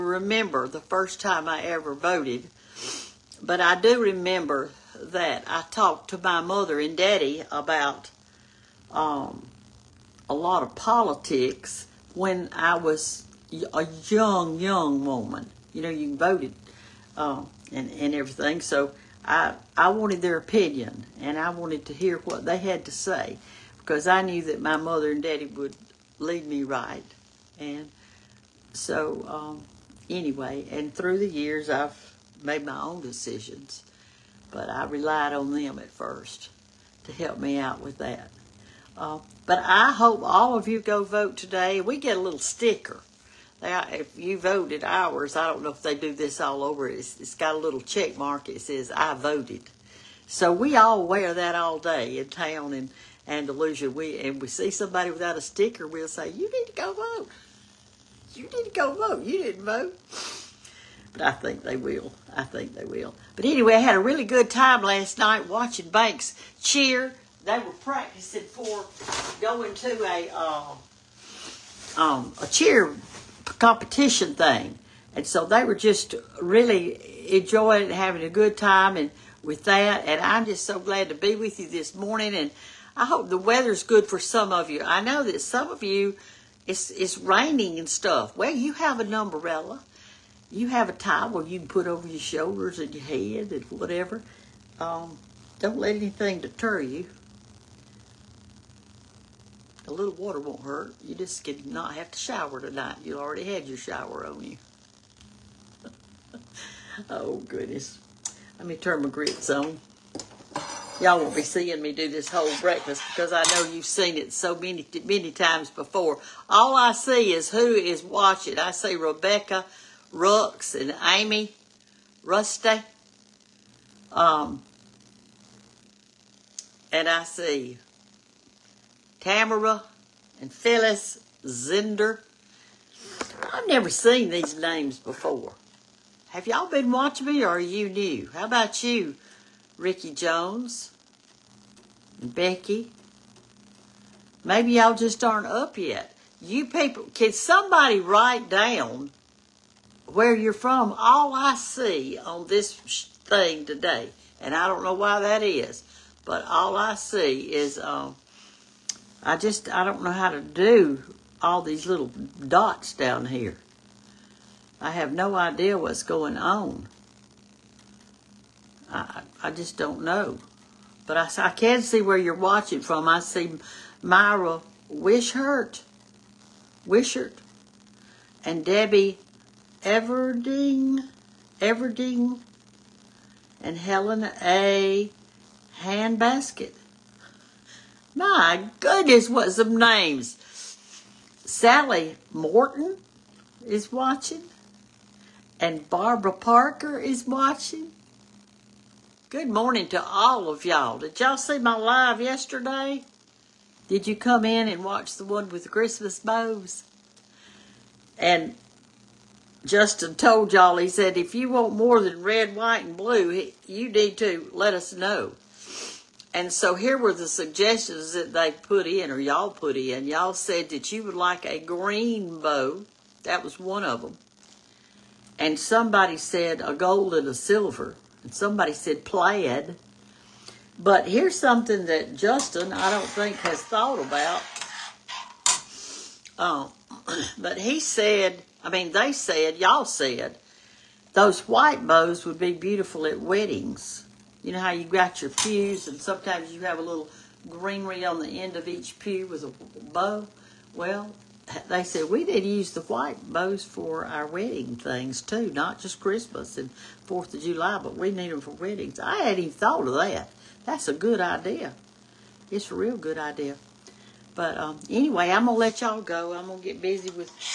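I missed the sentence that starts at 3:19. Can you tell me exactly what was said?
Good morning to all of y'all.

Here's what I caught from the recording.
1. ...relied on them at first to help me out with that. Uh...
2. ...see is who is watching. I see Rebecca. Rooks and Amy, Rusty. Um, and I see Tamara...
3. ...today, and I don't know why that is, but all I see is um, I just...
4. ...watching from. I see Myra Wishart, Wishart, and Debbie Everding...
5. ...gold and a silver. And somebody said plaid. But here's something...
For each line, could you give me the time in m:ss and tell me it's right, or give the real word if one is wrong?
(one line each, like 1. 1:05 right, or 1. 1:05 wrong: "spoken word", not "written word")
1. 0:34 right
2. 1:56 right
3. 2:33 right
4. 2:52 right
5. 3:46 right.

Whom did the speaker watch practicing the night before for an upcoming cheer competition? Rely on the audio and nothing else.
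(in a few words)
Banks.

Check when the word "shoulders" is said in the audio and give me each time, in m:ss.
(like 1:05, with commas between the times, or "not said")
1:32.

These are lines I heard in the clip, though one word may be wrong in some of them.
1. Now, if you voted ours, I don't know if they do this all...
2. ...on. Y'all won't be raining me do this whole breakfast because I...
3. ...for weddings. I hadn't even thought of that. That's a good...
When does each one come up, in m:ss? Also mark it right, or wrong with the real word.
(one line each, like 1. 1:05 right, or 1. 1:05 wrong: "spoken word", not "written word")
1. 0:43 right
2. 1:49 wrong: "seeing", not "raining"
3. 4:18 right.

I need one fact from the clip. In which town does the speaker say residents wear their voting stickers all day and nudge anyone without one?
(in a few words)
Andalusia.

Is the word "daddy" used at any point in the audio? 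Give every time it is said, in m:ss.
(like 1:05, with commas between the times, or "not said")
0:06, 0:25.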